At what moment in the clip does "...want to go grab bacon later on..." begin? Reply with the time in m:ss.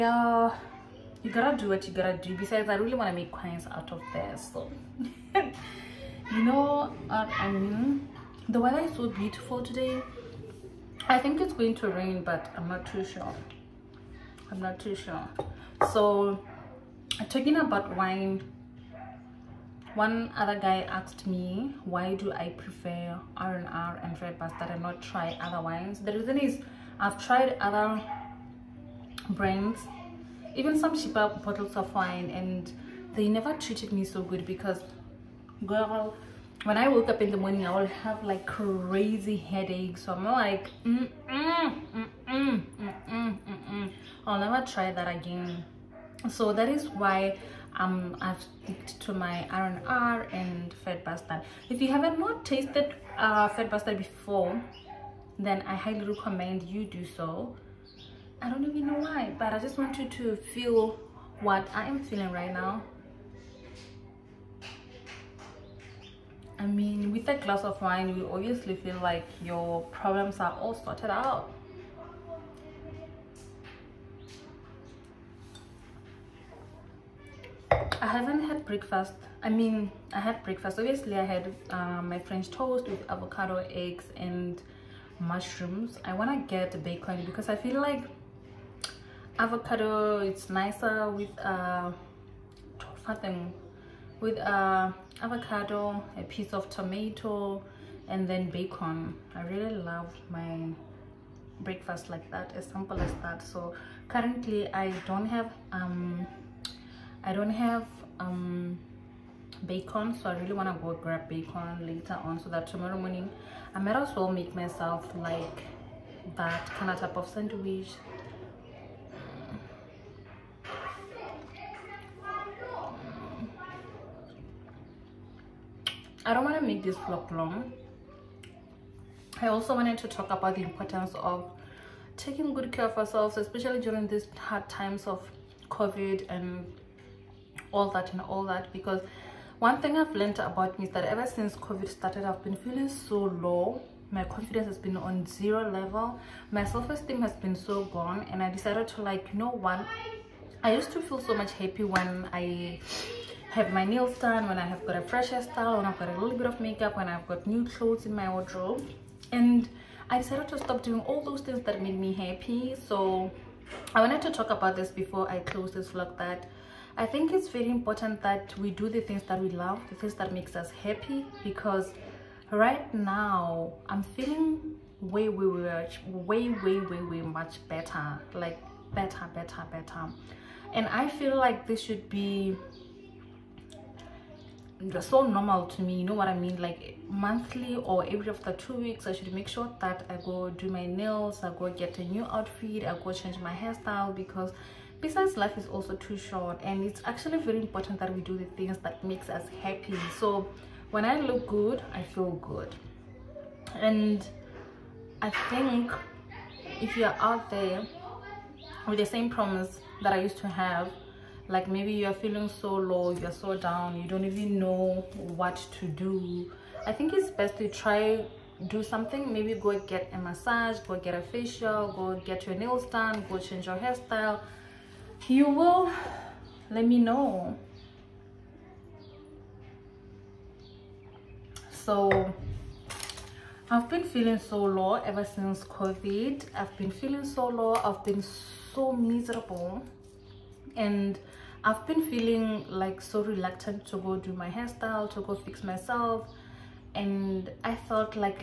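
1:50.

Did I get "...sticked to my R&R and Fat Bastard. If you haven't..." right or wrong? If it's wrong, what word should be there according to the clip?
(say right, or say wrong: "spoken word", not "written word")
right.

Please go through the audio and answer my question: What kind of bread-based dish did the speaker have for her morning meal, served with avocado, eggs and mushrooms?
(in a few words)
French toast.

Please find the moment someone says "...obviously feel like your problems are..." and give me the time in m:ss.
1:08.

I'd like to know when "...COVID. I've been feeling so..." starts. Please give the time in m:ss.
3:55.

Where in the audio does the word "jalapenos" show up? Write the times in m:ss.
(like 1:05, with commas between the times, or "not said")
not said.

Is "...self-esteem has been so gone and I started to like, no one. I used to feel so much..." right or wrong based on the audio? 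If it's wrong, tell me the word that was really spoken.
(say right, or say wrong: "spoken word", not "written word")
wrong: "decided", not "started".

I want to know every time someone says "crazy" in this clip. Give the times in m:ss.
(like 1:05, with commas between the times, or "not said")
0:38.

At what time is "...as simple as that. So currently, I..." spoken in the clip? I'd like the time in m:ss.
1:42.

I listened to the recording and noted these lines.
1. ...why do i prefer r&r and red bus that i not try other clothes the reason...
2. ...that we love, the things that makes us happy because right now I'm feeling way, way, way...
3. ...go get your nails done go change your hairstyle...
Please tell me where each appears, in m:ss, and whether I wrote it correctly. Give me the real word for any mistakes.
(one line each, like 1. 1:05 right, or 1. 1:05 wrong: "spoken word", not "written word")
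1. 0:21 wrong: "wines", not "clothes"
2. 2:49 right
3. 3:41 right.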